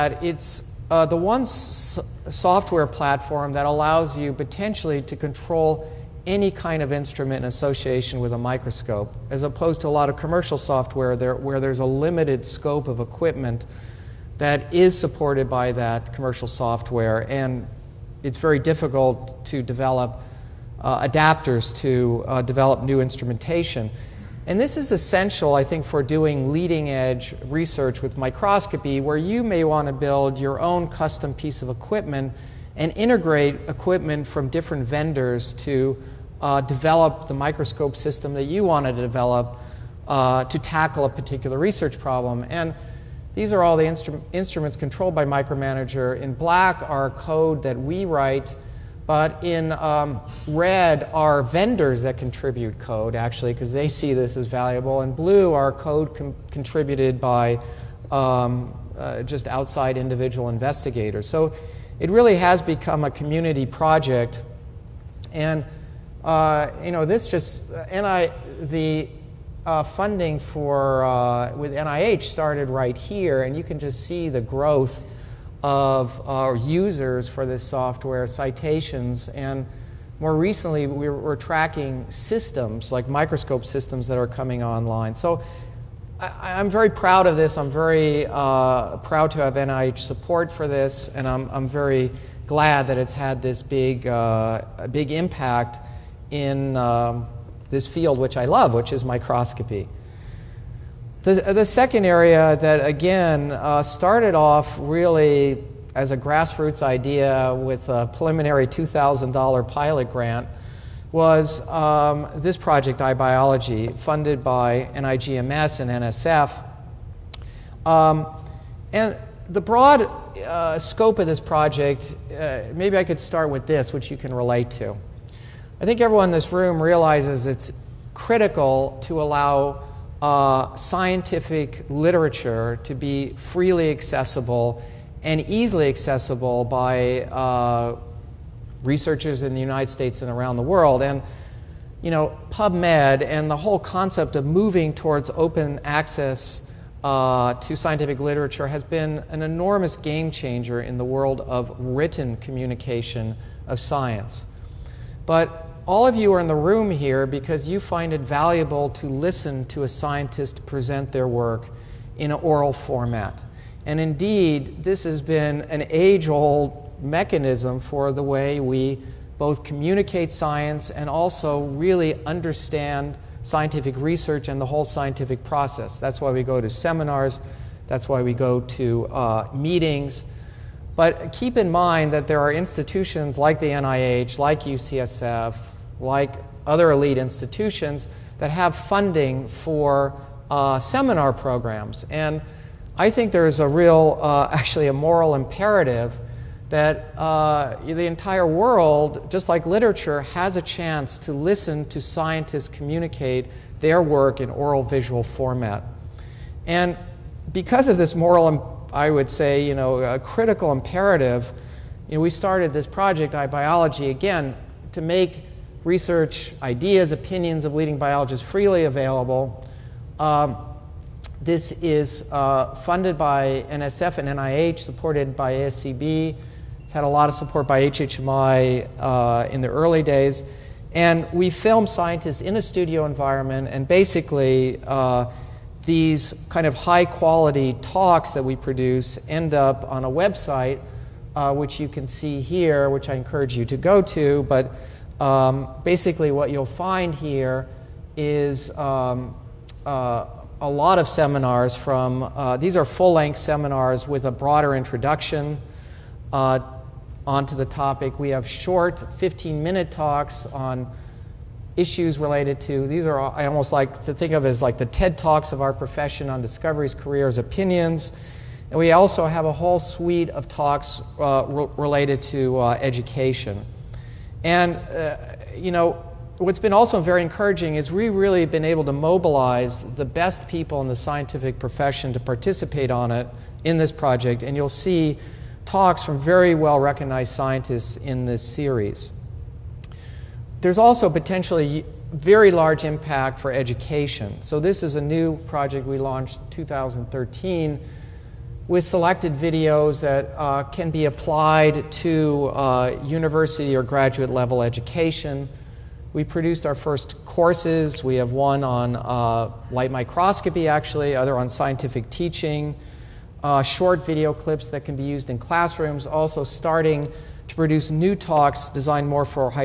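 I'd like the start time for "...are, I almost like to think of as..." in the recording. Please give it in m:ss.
4:23.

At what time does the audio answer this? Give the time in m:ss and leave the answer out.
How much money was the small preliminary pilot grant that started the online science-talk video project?
1:48.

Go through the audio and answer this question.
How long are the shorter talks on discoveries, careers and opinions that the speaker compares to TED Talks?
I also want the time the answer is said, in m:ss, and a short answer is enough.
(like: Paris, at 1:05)
15 minutes, at 4:19.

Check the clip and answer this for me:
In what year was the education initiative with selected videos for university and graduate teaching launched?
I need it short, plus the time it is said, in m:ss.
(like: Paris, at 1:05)
2013, at 4:56.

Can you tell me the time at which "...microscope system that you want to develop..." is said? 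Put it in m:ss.
0:37.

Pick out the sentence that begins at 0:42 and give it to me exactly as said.
And these are all the instru instruments controlled by Micromanager.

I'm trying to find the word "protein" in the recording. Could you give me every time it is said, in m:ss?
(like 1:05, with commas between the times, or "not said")
not said.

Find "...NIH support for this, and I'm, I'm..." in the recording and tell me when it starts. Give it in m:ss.
1:29.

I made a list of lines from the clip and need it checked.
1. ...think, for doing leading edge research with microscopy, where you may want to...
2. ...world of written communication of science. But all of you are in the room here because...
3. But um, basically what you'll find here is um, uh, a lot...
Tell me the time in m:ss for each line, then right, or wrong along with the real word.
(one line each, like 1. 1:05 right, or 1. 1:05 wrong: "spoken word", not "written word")
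1. 0:25 right
2. 2:31 right
3. 4:04 right.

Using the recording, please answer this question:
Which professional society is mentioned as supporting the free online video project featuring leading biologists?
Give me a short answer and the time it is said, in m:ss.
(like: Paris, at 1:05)
ASCB, at 3:45.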